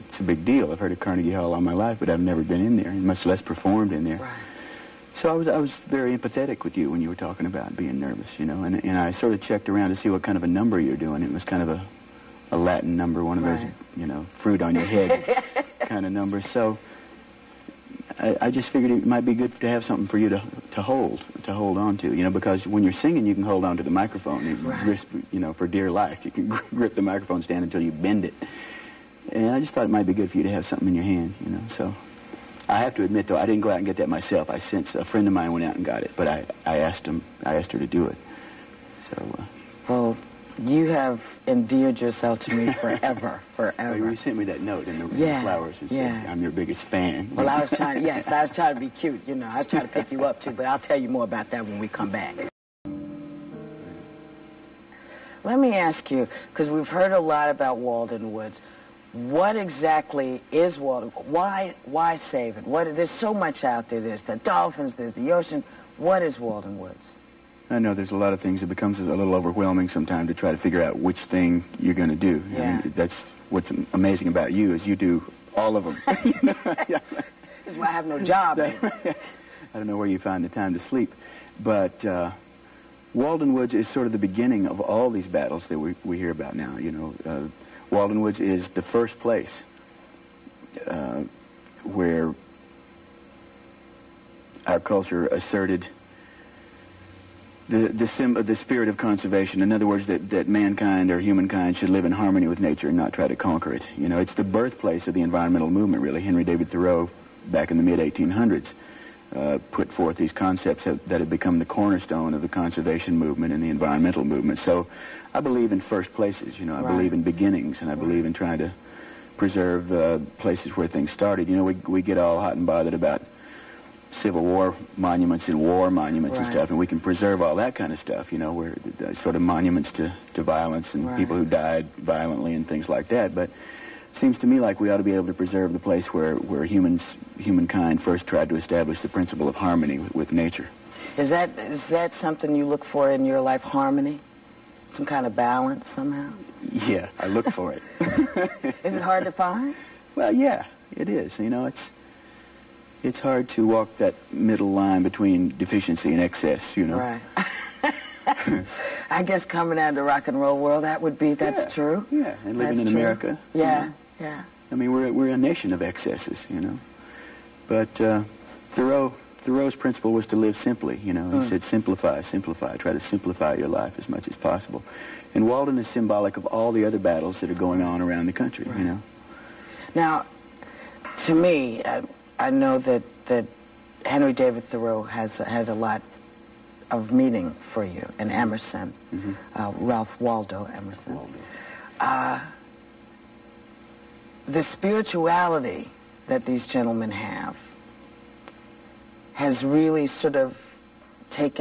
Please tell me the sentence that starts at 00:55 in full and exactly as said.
Let me ask you, because we've heard a lot about Walden Woods.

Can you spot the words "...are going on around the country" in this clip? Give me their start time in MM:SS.
02:57.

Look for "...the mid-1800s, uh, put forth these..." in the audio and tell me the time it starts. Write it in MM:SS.
01:47.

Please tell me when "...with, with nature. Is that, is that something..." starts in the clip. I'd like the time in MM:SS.
02:19.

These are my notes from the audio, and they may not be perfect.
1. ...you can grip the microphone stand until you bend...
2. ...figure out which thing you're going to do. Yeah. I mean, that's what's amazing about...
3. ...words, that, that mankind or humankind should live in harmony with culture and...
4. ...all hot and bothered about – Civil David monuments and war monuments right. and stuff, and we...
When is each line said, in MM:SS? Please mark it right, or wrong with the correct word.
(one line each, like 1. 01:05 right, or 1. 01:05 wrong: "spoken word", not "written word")
1. 00:26 right
2. 01:10 right
3. 01:39 wrong: "nature", not "culture"
4. 02:02 wrong: "War", not "David".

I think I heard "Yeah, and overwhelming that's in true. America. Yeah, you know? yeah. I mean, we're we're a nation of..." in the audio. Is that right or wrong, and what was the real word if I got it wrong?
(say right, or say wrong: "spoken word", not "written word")
wrong: "living", not "overwhelming".